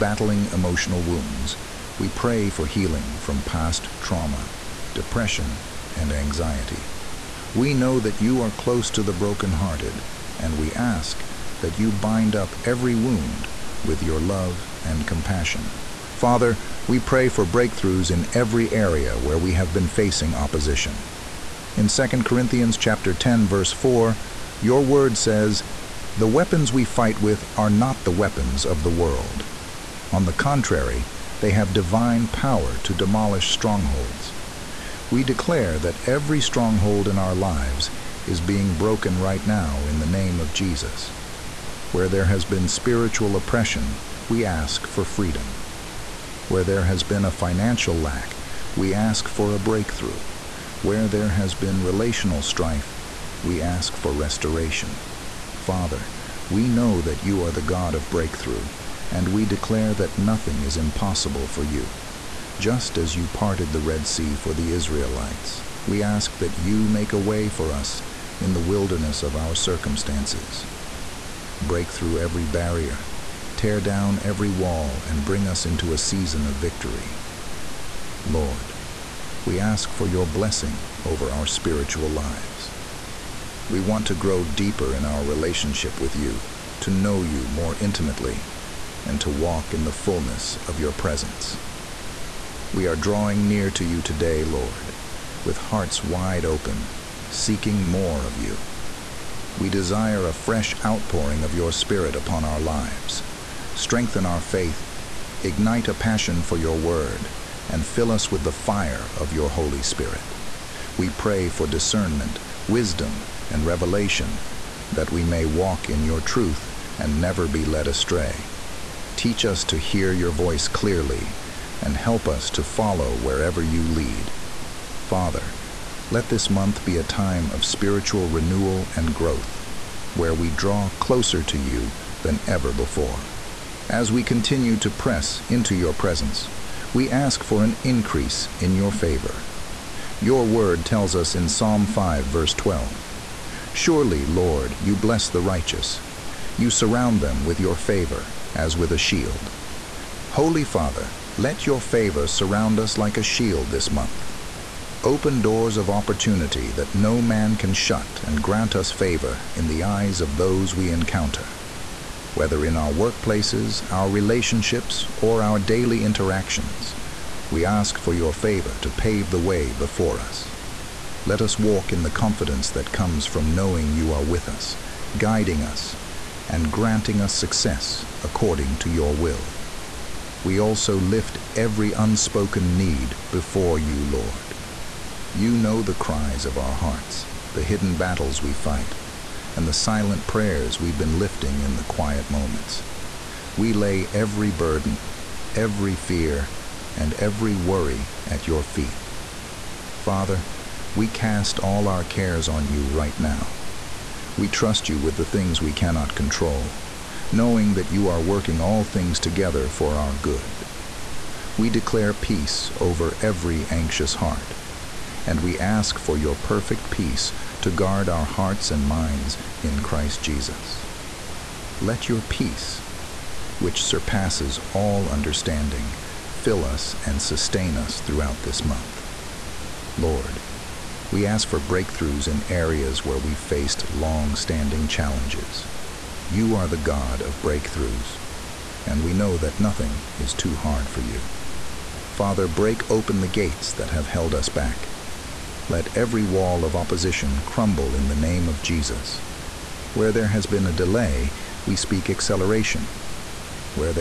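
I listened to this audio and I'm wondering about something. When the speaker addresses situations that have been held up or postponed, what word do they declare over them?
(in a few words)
Acceleration.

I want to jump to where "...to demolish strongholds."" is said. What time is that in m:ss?
0:32.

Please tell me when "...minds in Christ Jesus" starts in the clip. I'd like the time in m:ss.
3:38.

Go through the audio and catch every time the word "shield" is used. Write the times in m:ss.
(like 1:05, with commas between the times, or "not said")
2:28, 2:33.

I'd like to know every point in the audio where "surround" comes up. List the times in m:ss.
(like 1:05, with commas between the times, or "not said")
2:26, 2:32.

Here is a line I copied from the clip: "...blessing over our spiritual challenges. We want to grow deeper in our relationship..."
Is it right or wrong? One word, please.
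wrong.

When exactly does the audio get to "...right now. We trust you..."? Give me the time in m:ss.
3:22.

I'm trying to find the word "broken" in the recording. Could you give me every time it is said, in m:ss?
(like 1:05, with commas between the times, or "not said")
0:09, 0:38.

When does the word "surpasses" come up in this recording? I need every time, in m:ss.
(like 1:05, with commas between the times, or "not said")
3:43.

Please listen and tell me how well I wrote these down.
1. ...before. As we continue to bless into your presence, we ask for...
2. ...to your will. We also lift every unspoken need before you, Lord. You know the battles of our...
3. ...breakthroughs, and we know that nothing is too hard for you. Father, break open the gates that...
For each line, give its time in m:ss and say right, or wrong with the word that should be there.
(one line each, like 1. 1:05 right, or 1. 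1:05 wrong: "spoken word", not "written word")
1. 2:12 wrong: "press", not "bless"
2. 2:58 wrong: "cries", not "battles"
3. 3:57 right.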